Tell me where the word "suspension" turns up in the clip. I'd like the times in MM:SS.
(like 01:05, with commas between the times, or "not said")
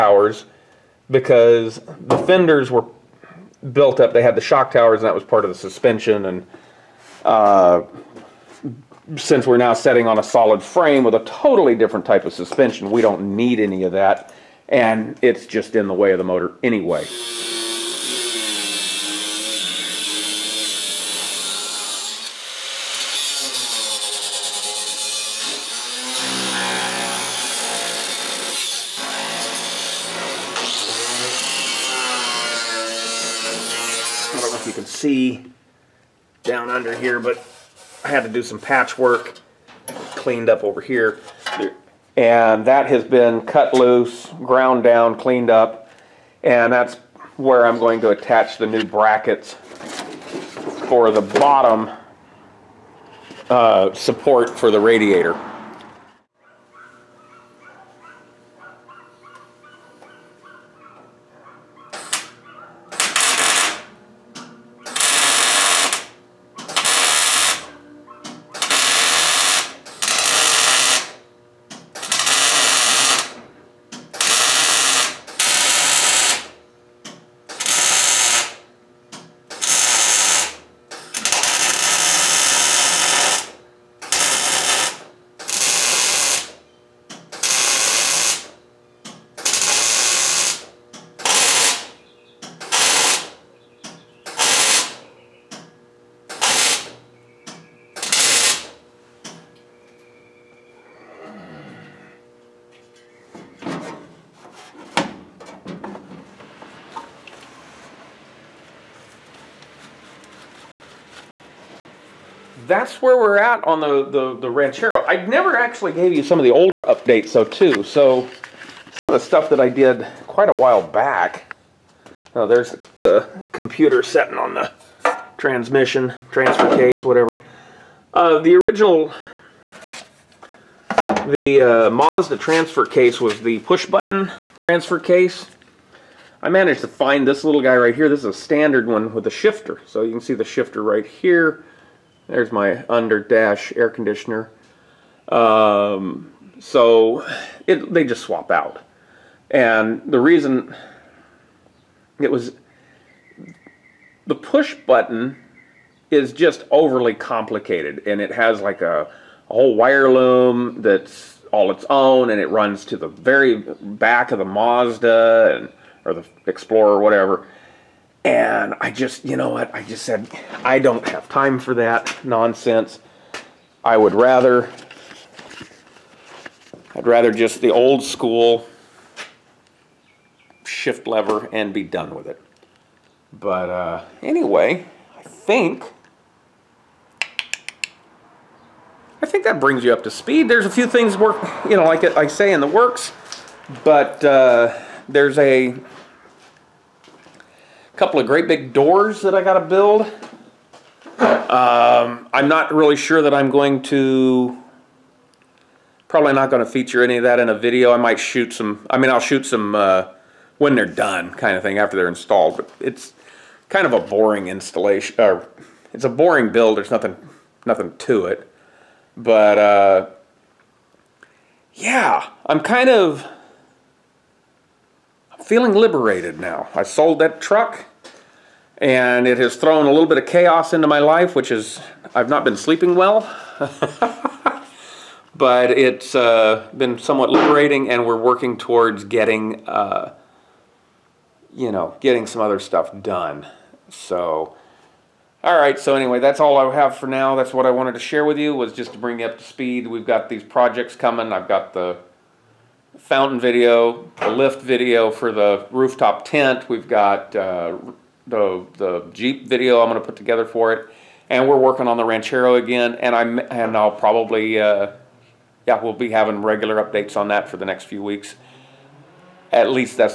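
00:05, 00:12.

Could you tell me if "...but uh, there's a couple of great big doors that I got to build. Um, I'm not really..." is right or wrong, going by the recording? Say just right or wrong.
right.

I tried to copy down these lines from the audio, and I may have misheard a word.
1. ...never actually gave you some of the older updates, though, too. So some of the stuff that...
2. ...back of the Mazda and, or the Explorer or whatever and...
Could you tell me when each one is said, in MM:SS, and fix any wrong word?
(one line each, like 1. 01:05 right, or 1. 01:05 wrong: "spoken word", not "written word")
1. 01:55 right
2. 02:43 right.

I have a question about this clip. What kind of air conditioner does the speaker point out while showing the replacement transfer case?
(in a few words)
under dash.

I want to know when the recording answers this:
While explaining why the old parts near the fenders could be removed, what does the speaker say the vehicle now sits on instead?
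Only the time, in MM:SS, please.
00:10.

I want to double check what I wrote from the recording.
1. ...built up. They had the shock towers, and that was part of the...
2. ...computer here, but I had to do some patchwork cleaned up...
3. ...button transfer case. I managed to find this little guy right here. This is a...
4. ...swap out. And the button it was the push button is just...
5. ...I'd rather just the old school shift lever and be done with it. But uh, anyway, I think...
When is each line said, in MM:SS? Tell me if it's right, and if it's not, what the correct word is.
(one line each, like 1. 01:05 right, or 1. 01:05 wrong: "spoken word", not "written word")
1. 00:03 right
2. 00:36 wrong: "under", not "computer"
3. 02:13 right
4. 02:28 wrong: "reason", not "button"
5. 02:56 right.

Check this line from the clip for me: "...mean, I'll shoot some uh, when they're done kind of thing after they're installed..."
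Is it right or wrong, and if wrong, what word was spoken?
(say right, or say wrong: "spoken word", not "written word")
right.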